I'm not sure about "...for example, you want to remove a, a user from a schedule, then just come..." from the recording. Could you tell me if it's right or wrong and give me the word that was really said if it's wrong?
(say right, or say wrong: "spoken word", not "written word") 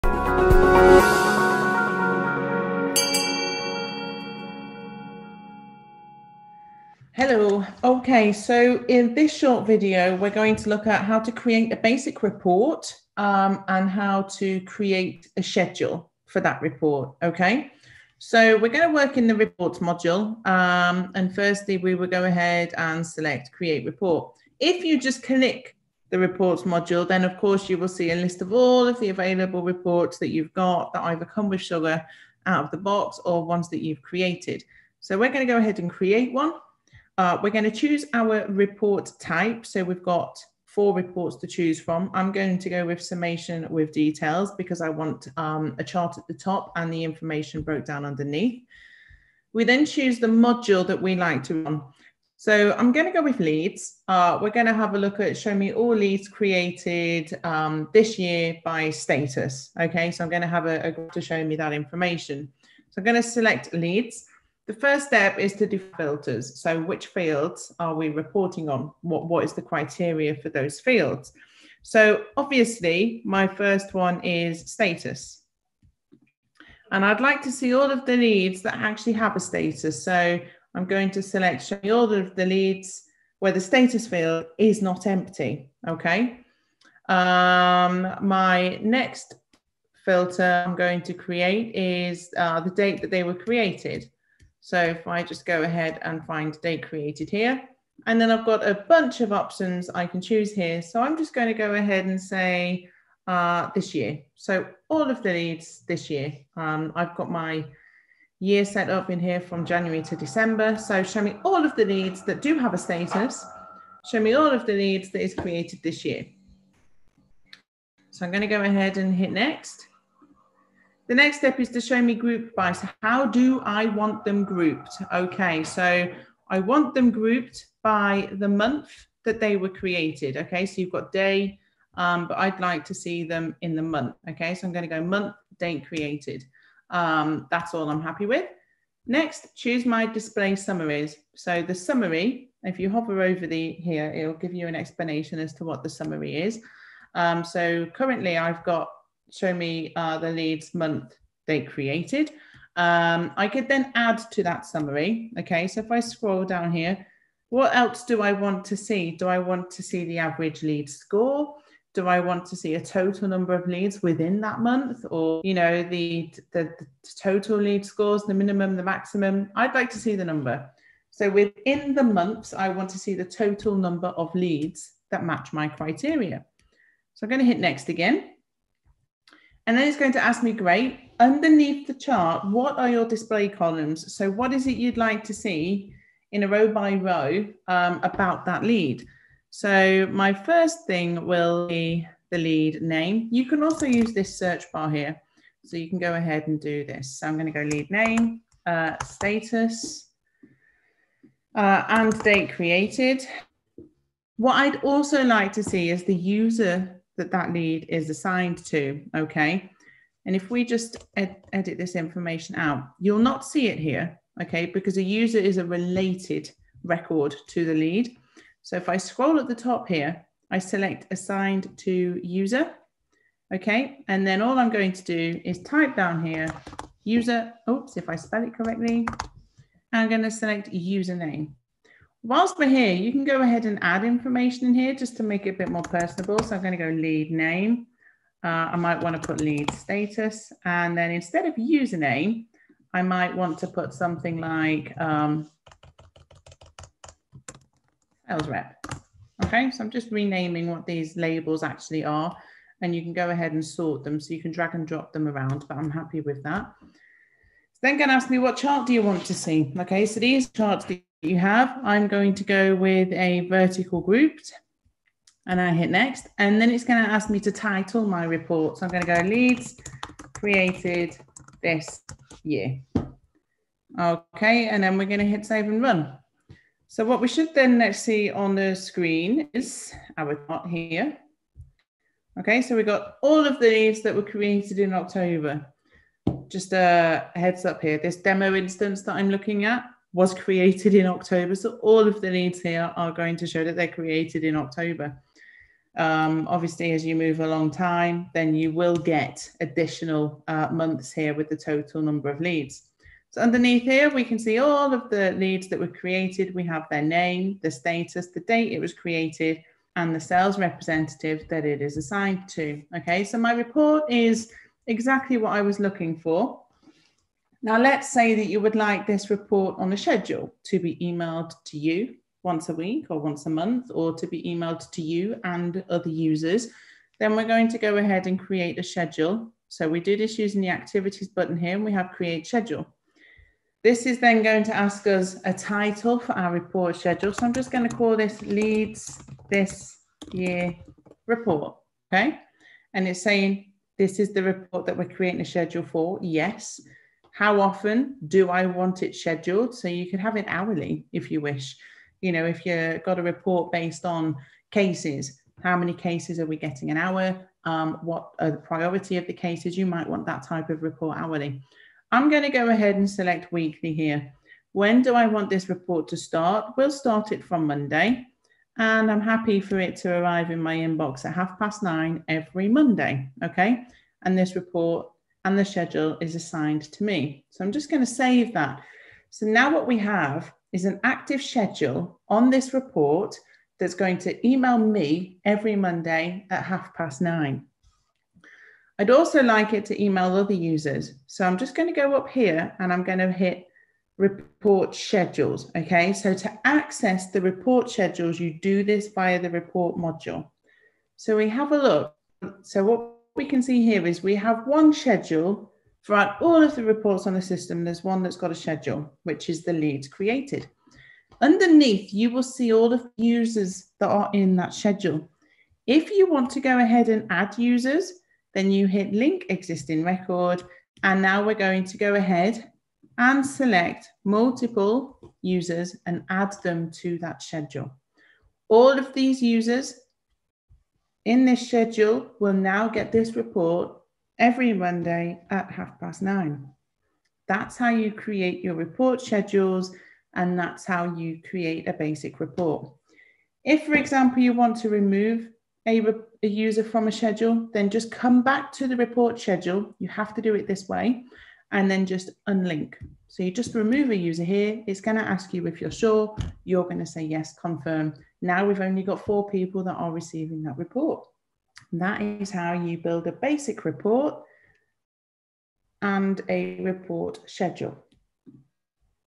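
right.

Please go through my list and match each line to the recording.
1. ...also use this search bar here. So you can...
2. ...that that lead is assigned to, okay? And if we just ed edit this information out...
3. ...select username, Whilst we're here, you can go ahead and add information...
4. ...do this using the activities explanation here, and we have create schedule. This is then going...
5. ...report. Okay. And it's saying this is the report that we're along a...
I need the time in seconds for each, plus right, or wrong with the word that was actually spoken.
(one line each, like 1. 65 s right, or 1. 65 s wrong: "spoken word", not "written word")
1. 193 s right
2. 207 s right
3. 230 s right
4. 329 s wrong: "button", not "explanation"
5. 341 s wrong: "creating", not "along".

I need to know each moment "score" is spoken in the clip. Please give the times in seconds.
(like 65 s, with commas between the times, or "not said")
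160 s, 167 s.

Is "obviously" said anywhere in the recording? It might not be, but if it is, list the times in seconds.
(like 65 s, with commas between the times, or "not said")
72 s, 296 s.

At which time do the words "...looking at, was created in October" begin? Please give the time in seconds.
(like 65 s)
289 s.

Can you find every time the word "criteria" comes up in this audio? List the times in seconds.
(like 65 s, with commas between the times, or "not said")
69 s, 175 s.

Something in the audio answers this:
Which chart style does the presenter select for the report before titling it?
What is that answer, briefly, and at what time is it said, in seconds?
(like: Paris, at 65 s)
Vertical grouped, at 263 s.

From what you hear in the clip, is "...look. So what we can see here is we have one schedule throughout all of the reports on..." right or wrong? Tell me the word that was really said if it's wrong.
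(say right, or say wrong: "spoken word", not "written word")
right.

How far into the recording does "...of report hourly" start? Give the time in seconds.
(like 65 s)
360 s.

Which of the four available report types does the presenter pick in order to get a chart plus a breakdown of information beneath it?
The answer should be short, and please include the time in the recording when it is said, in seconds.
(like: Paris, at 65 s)
Summation with details, at 42 s.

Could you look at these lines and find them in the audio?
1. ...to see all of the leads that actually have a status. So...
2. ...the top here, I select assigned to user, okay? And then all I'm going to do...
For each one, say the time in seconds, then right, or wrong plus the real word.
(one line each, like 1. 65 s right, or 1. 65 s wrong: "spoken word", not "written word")
1. 77 s right
2. 219 s right.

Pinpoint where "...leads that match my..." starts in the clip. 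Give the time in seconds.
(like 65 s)
174 s.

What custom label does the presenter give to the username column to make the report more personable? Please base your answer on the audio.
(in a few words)
Sales rep.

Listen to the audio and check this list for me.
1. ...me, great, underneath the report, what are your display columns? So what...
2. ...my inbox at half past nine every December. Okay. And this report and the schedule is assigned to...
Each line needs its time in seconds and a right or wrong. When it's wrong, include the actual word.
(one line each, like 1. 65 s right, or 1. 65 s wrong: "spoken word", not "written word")
1. 180 s wrong: "chart", not "report"
2. 370 s wrong: "Monday", not "December".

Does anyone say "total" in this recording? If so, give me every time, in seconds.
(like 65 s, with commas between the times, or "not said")
162 s, 167 s, 173 s, 301 s.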